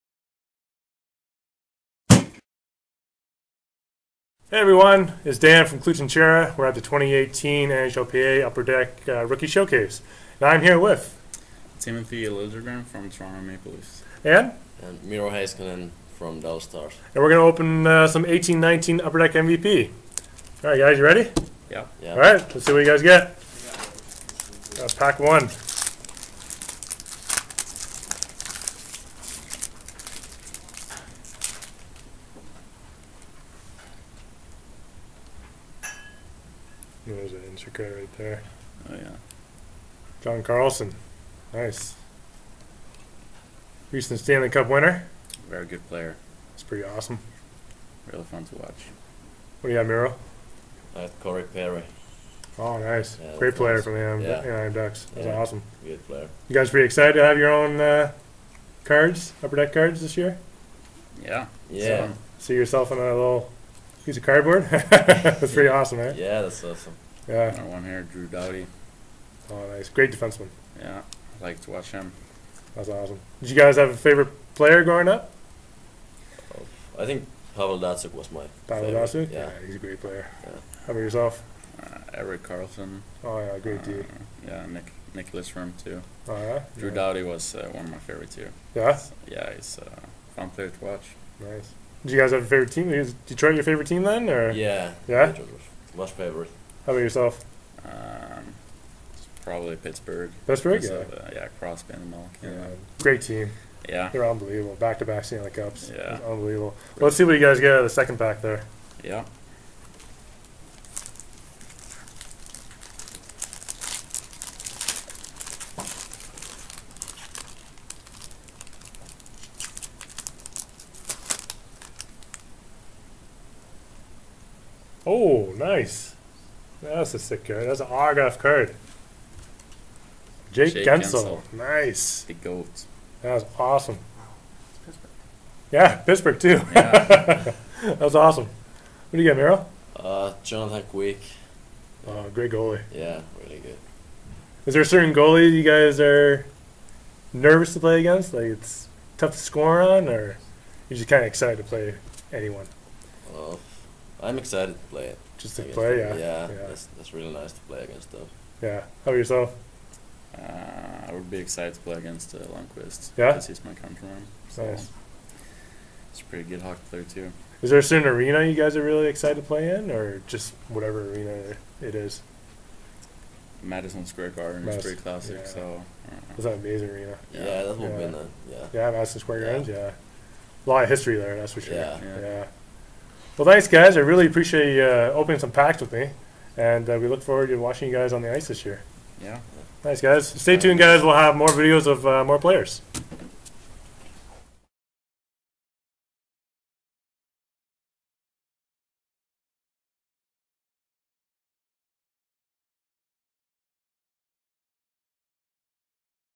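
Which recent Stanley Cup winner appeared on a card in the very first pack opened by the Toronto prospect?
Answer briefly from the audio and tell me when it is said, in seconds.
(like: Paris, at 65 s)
John Carlson, at 40 s.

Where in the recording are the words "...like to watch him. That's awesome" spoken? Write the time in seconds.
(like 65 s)
71 s.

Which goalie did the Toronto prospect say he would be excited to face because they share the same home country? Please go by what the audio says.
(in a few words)
Lundqvist.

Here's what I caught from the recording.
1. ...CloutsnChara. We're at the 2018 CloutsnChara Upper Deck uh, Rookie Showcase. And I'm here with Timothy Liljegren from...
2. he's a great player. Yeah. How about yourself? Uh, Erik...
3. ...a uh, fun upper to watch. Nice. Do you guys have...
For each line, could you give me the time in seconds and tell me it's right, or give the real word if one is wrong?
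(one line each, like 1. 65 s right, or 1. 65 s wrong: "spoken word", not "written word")
1. 5 s wrong: "NHLPA", not "CloutsnChara"
2. 79 s right
3. 89 s wrong: "player", not "upper".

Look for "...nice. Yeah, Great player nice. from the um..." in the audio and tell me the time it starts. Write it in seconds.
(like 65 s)
52 s.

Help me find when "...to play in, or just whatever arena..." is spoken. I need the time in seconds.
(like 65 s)
169 s.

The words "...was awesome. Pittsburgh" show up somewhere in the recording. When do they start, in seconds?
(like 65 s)
133 s.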